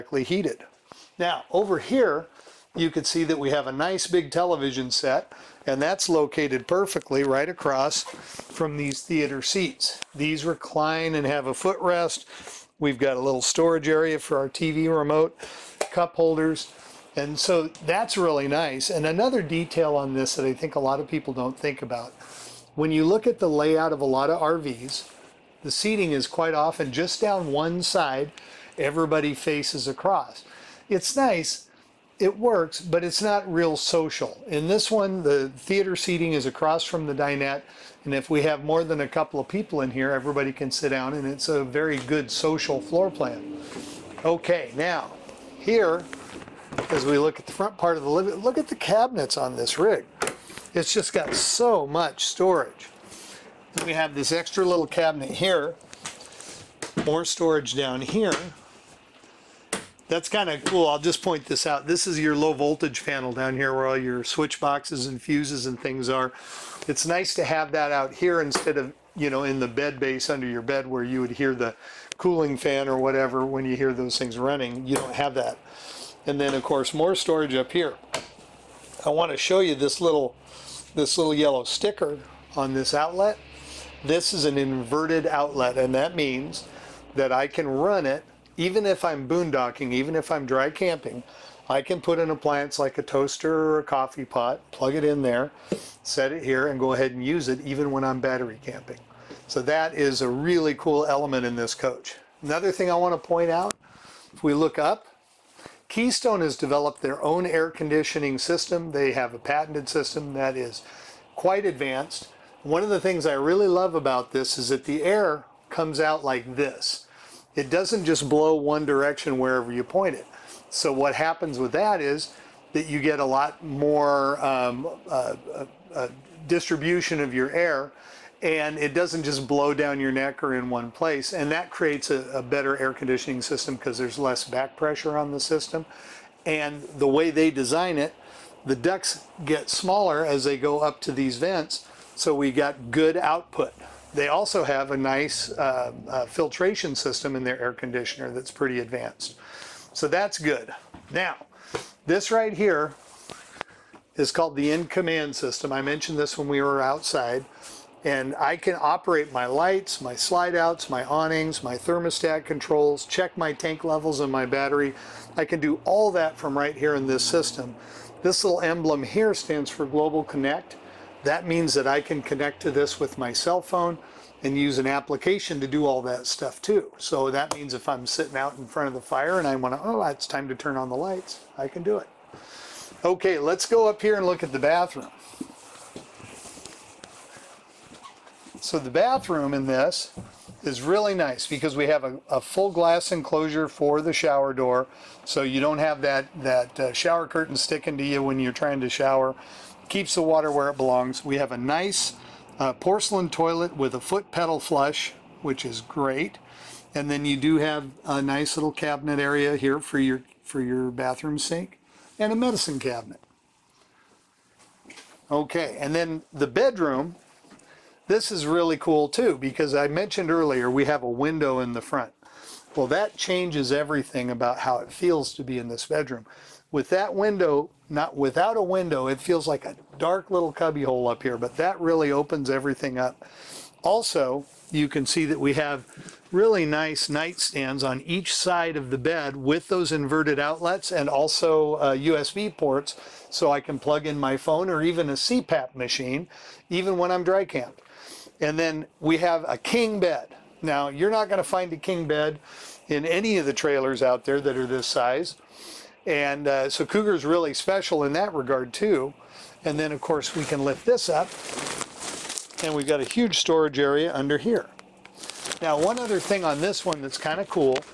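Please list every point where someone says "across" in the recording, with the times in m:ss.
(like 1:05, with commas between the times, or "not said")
0:07, 0:29, 0:36.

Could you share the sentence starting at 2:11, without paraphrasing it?
And that creates a, a better air conditioning system because there's less back pressure on the system.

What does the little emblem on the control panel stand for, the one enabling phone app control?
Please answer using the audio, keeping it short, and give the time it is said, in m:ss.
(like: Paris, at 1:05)
Global Connect, at 2:49.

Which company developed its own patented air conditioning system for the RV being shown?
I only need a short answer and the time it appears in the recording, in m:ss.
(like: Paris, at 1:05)
Keystone, at 1:45.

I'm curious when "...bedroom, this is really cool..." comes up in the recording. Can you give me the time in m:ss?
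3:36.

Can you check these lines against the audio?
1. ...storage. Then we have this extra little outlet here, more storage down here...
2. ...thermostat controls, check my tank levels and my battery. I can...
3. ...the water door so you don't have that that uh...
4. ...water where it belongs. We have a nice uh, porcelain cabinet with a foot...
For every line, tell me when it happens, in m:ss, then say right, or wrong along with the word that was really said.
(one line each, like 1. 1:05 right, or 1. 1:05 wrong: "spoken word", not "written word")
1. 0:52 wrong: "cabinet", not "outlet"
2. 2:41 right
3. 3:14 wrong: "shower", not "water"
4. 3:20 wrong: "toilet", not "cabinet".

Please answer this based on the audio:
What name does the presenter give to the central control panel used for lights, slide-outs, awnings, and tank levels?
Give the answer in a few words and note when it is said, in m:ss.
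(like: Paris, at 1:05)
In Command system, at 2:34.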